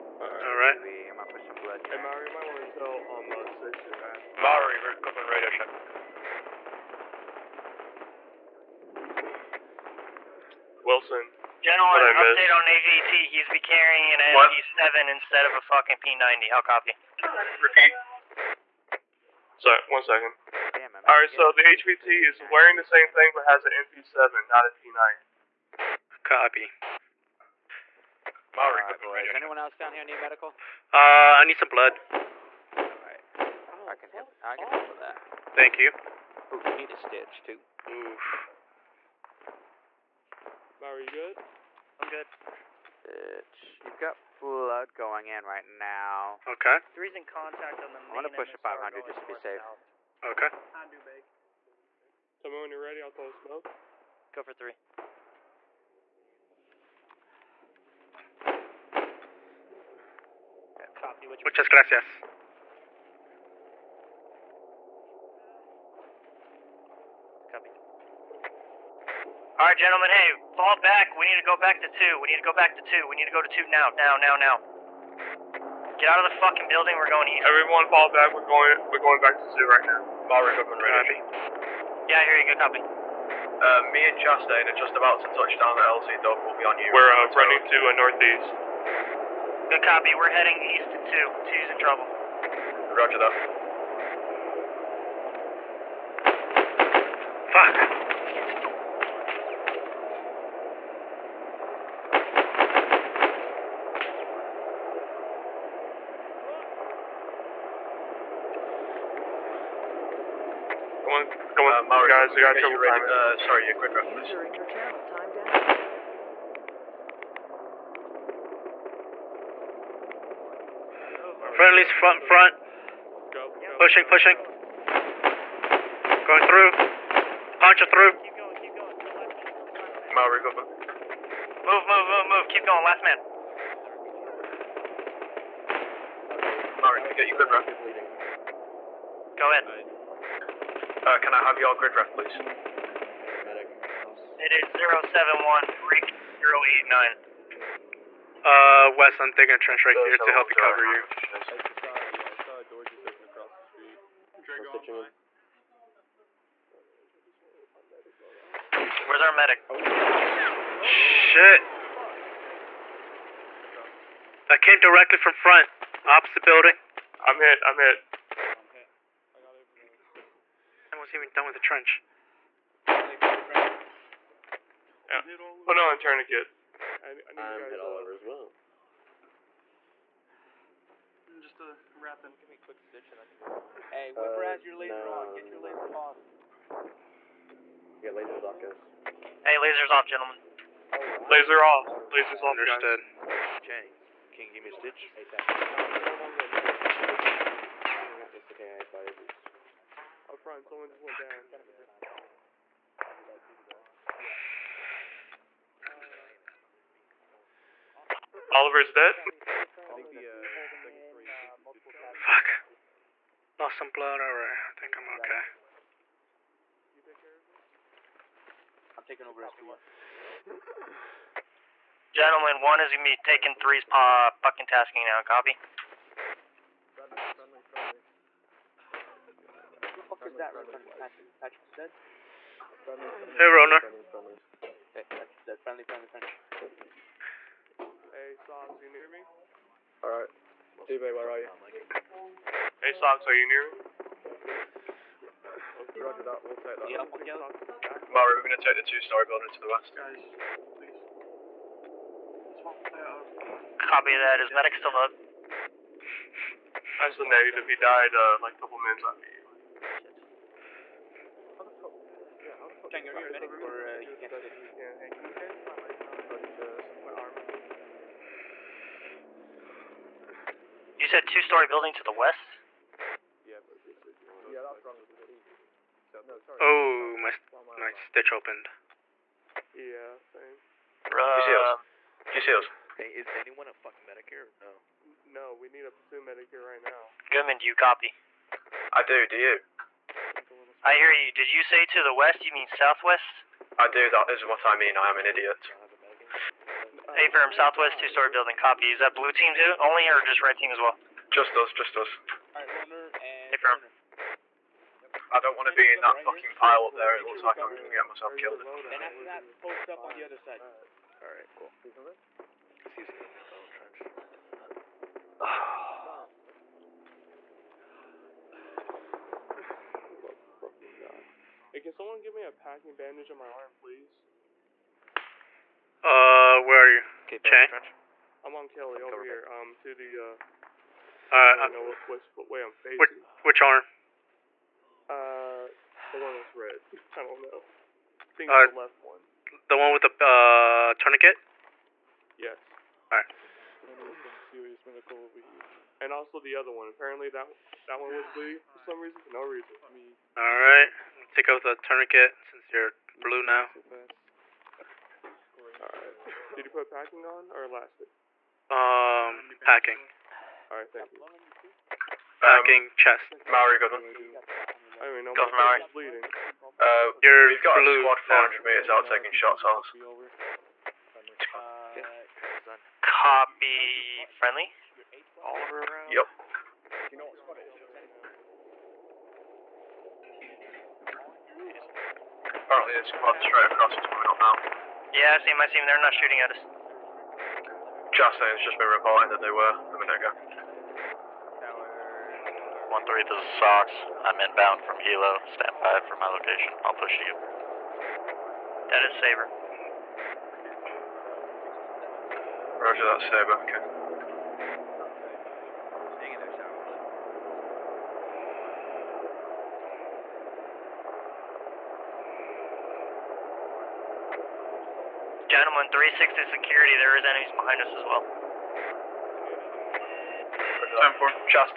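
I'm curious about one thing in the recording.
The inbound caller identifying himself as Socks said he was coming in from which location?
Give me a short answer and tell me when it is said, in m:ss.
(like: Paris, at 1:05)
Hilo, at 6:34.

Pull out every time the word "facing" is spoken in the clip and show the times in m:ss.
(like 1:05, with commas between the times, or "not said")
5:32.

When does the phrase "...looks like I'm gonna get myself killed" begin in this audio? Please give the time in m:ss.
5:07.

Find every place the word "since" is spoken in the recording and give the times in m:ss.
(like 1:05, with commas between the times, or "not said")
5:52.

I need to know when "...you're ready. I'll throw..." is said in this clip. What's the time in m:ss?
0:52.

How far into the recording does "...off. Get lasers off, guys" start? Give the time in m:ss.
3:05.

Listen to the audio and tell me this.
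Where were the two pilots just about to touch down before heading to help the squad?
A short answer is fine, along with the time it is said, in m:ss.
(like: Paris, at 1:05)
LZ Dog, at 1:25.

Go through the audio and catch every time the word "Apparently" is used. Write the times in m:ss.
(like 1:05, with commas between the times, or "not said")
5:46, 6:22.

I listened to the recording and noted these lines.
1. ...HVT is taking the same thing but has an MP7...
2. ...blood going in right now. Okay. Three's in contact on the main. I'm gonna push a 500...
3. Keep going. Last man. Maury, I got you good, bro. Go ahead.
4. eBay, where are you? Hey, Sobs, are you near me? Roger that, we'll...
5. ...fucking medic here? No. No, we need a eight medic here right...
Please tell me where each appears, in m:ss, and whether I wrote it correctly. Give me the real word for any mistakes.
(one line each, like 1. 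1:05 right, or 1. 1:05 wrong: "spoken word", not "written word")
1. 0:21 wrong: "wearing", not "taking"
2. 0:44 right
3. 2:12 right
4. 4:00 right
5. 4:43 wrong: "two", not "eight".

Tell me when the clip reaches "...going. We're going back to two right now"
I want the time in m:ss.
1:18.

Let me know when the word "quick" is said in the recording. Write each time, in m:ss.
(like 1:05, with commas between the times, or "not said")
1:53, 3:02.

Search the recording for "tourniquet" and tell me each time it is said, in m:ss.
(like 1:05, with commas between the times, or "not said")
2:55, 5:40, 5:51.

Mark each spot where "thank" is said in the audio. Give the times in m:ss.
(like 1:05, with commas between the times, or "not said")
0:35, 6:00.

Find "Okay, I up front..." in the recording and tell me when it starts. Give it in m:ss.
3:18.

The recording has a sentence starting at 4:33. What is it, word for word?
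Yeah, that's wrong Oh, my, my stitch opened.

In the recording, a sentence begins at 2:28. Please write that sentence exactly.
Uh, Wes, I'm digging a trench right here to help you cover you.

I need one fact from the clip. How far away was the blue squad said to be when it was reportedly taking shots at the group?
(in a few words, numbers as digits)
400 meters.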